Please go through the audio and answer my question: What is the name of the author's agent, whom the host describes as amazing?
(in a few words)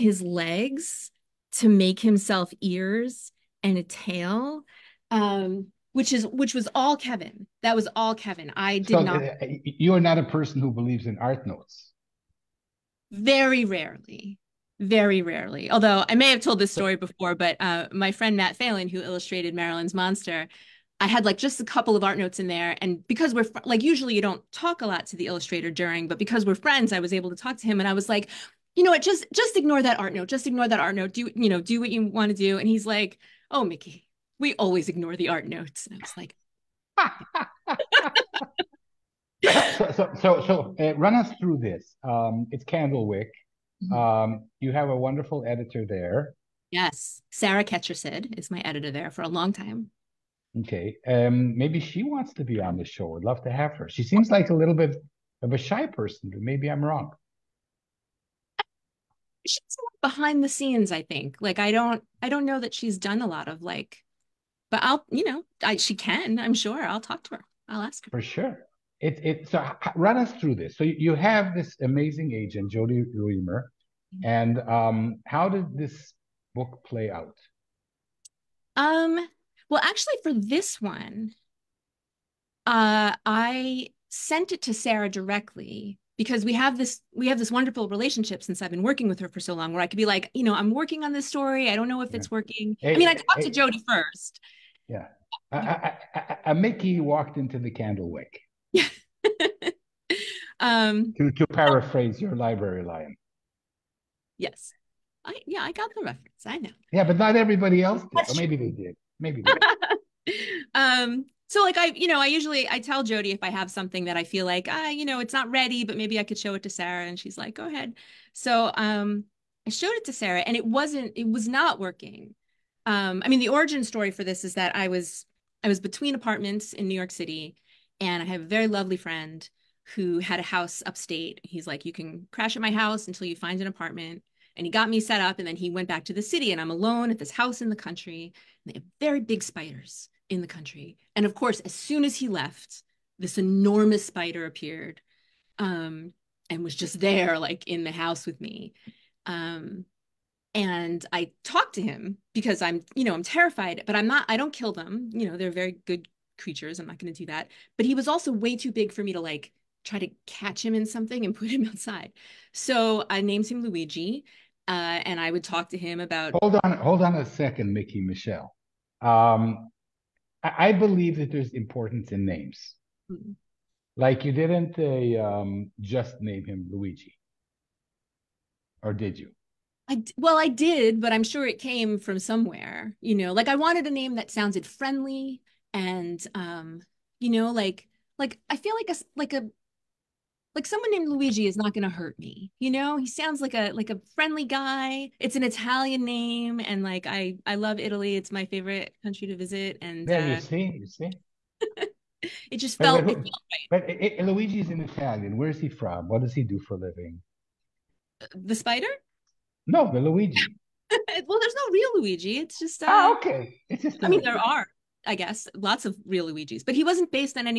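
Jodi Reamer.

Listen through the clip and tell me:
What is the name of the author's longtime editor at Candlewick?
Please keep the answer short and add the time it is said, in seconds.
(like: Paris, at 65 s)
Sarah Ketchersid, at 47 s.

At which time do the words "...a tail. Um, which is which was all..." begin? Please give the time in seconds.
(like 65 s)
3 s.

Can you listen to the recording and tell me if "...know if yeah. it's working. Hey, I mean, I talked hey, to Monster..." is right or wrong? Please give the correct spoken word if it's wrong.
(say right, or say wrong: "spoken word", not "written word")
wrong: "Jody", not "Monster".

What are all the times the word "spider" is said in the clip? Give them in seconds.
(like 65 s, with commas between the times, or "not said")
139 s, 144 s, 208 s.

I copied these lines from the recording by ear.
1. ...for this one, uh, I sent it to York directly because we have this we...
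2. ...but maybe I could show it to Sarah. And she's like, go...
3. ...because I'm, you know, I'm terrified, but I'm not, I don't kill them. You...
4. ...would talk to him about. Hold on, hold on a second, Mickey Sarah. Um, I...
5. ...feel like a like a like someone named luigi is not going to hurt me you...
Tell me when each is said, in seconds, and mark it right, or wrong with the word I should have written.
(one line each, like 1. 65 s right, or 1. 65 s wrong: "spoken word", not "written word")
1. 80 s wrong: "Sarah", not "York"
2. 115 s right
3. 152 s right
4. 165 s wrong: "Michelle", not "Sarah"
5. 188 s right.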